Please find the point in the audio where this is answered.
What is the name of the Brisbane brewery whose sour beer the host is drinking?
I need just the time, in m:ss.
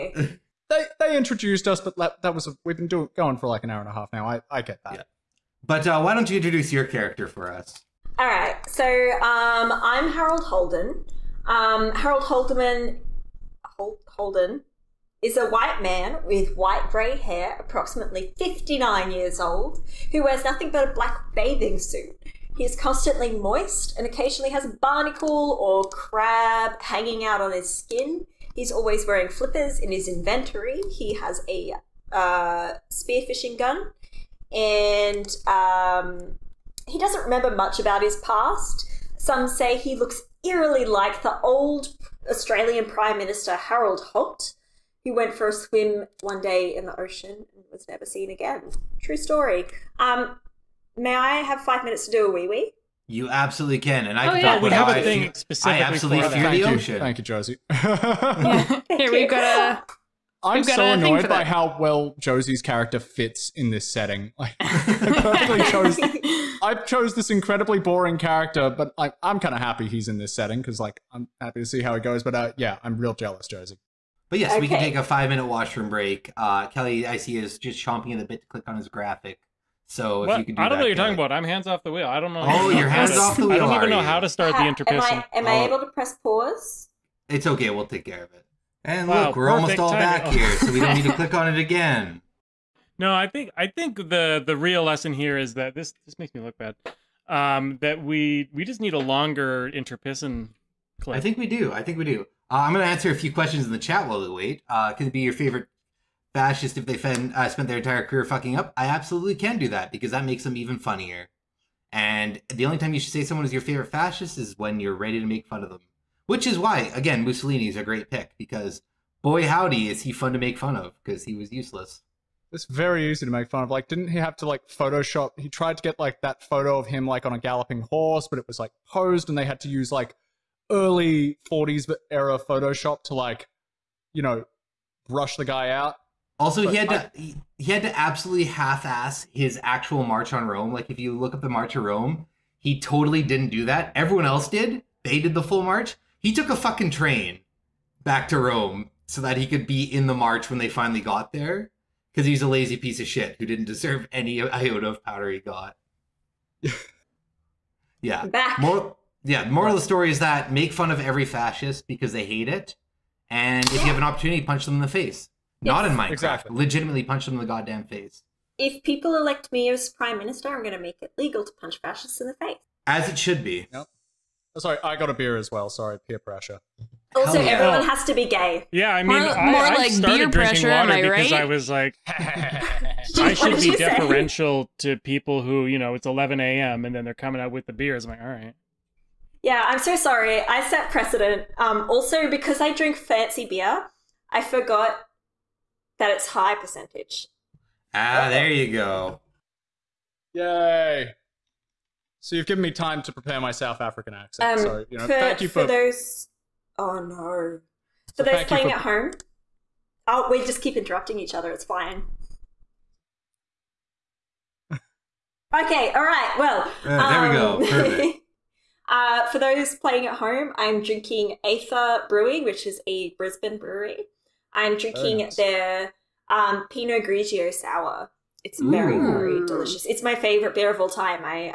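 3:41.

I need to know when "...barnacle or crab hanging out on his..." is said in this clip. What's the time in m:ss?
0:24.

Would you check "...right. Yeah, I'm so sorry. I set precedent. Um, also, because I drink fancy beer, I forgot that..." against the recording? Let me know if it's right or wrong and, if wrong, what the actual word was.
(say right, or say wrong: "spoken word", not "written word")
right.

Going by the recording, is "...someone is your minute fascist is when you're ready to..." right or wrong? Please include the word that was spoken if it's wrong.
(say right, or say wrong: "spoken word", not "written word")
wrong: "favorite", not "minute".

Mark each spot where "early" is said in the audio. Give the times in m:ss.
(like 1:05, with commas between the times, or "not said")
2:10.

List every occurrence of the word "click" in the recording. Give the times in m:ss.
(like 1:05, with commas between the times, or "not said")
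1:18, 1:31.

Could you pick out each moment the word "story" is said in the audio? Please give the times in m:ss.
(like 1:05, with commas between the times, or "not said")
0:49, 2:39.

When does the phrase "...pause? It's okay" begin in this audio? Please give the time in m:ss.
1:26.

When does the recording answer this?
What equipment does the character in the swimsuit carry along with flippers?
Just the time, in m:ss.
0:32.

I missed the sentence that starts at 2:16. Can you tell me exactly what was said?
Also, but he had to I, he, he had to absolutely half-ass his actual March on Rome.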